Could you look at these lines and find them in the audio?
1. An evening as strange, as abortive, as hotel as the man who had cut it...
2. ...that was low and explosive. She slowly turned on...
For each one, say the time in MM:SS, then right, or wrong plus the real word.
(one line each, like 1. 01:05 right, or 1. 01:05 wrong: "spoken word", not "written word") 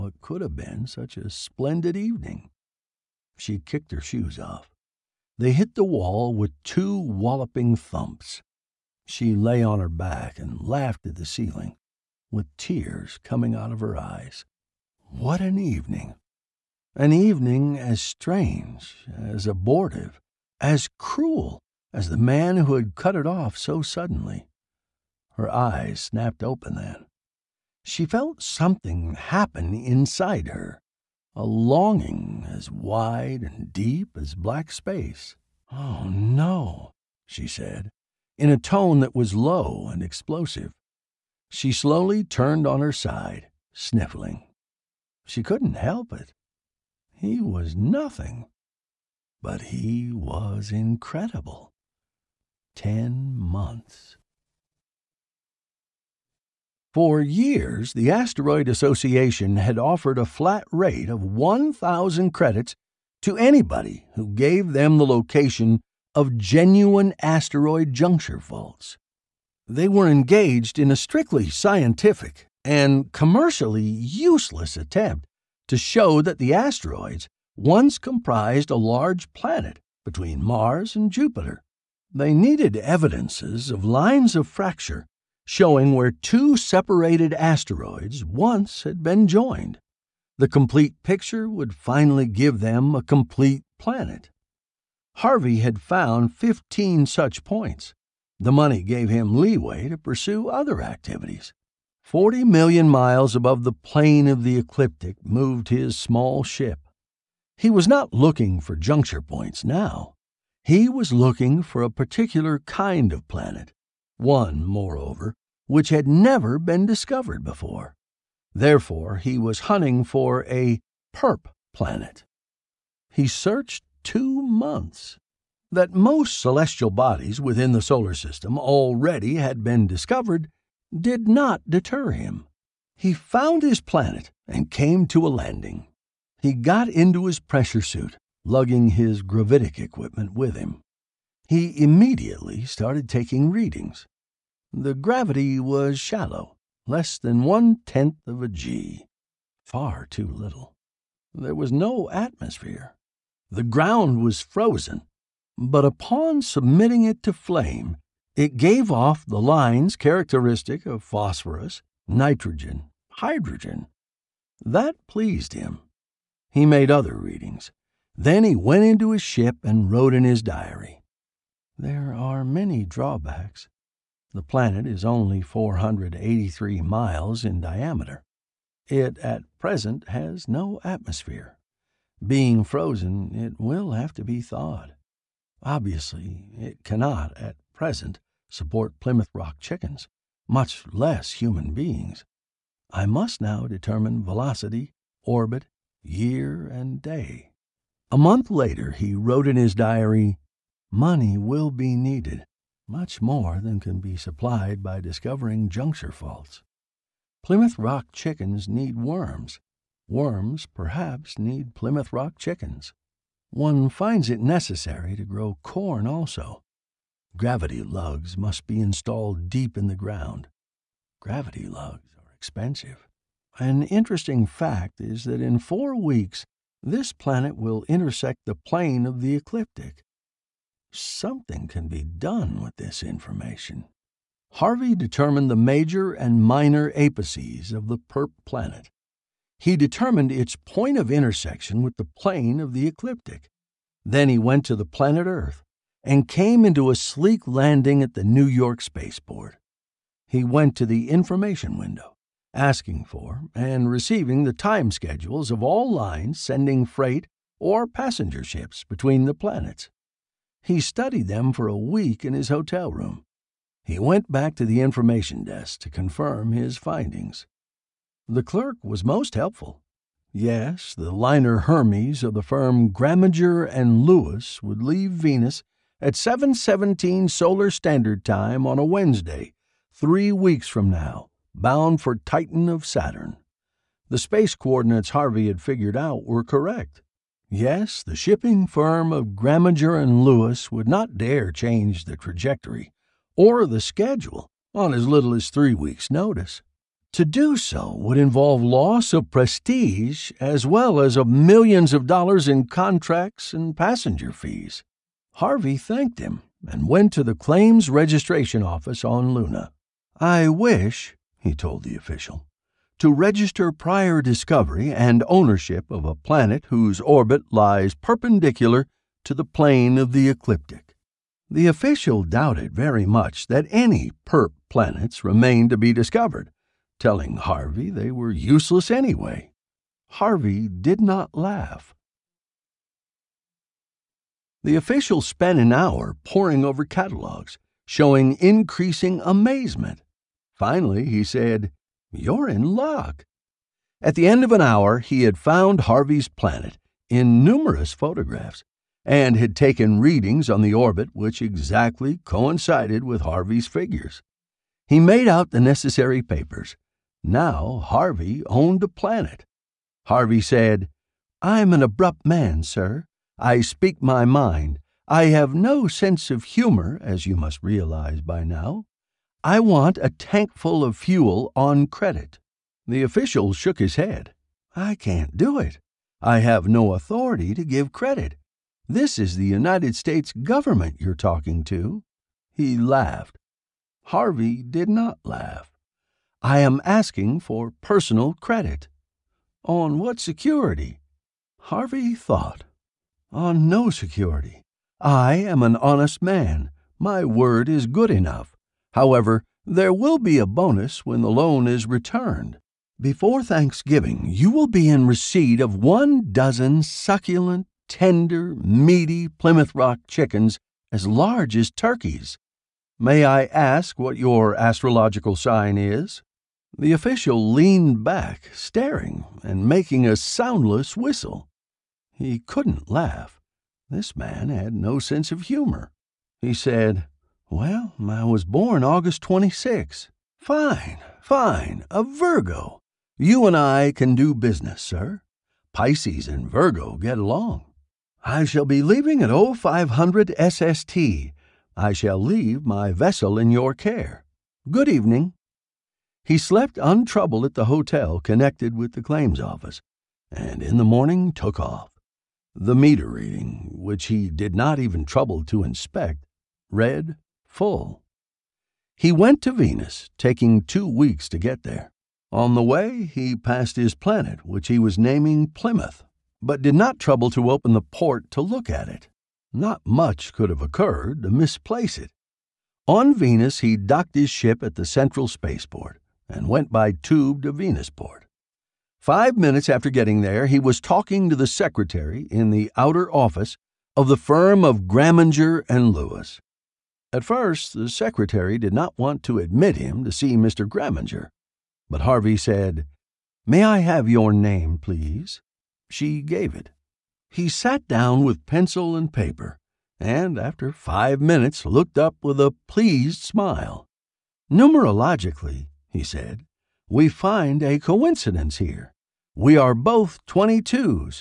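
1. 00:16 wrong: "cruel", not "hotel"
2. 00:39 right.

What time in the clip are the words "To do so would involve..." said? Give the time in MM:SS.
04:57.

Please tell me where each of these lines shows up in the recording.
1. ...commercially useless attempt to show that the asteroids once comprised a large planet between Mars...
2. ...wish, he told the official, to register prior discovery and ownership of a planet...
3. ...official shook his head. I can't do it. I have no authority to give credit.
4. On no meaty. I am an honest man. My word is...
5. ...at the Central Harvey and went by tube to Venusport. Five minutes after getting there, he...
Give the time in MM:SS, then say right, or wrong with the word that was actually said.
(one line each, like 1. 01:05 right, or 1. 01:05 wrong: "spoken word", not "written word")
1. 01:13 right
2. 05:10 right
3. 06:13 right
4. 06:33 wrong: "security", not "meaty"
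5. 07:54 wrong: "Spaceport", not "Harvey".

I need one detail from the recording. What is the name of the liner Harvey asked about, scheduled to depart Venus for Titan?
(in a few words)
Hermes.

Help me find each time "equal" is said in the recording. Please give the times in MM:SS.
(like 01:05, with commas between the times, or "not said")
not said.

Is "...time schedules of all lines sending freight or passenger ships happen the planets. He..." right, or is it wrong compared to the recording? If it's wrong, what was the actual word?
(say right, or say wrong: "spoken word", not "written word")
wrong: "between", not "happen".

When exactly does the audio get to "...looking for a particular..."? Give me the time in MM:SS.
01:51.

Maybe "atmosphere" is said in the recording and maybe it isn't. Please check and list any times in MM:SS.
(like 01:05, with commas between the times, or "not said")
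02:32, 03:00.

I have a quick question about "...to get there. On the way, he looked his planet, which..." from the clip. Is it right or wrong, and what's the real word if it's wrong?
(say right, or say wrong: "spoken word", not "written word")
wrong: "passed", not "looked".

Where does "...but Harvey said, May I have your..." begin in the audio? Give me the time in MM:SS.
08:11.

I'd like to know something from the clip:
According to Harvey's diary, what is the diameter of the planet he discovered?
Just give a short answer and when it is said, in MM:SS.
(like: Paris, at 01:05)
483 miles, at 02:55.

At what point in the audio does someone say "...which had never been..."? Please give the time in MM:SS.
01:55.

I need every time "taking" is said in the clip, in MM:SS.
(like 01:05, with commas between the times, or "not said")
02:23, 07:40.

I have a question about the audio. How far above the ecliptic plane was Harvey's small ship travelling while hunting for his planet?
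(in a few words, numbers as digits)
40 million miles.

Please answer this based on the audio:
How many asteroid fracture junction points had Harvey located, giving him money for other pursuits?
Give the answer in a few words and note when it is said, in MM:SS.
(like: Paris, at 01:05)
15, at 01:36.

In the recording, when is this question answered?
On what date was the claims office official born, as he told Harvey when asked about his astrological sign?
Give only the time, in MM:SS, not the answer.
07:08.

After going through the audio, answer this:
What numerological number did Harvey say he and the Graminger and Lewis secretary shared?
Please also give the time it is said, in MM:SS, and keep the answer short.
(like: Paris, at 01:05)
22, at 08:30.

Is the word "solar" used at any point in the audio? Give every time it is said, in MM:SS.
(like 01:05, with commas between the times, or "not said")
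02:07, 04:37.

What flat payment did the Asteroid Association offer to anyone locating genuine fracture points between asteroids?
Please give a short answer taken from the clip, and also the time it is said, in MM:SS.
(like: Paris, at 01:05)
1,000 credits, at 01:01.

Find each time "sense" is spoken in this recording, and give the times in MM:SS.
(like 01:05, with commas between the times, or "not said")
06:05, 07:04.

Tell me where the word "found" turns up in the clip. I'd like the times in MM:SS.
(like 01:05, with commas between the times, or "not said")
01:35, 02:13, 05:45.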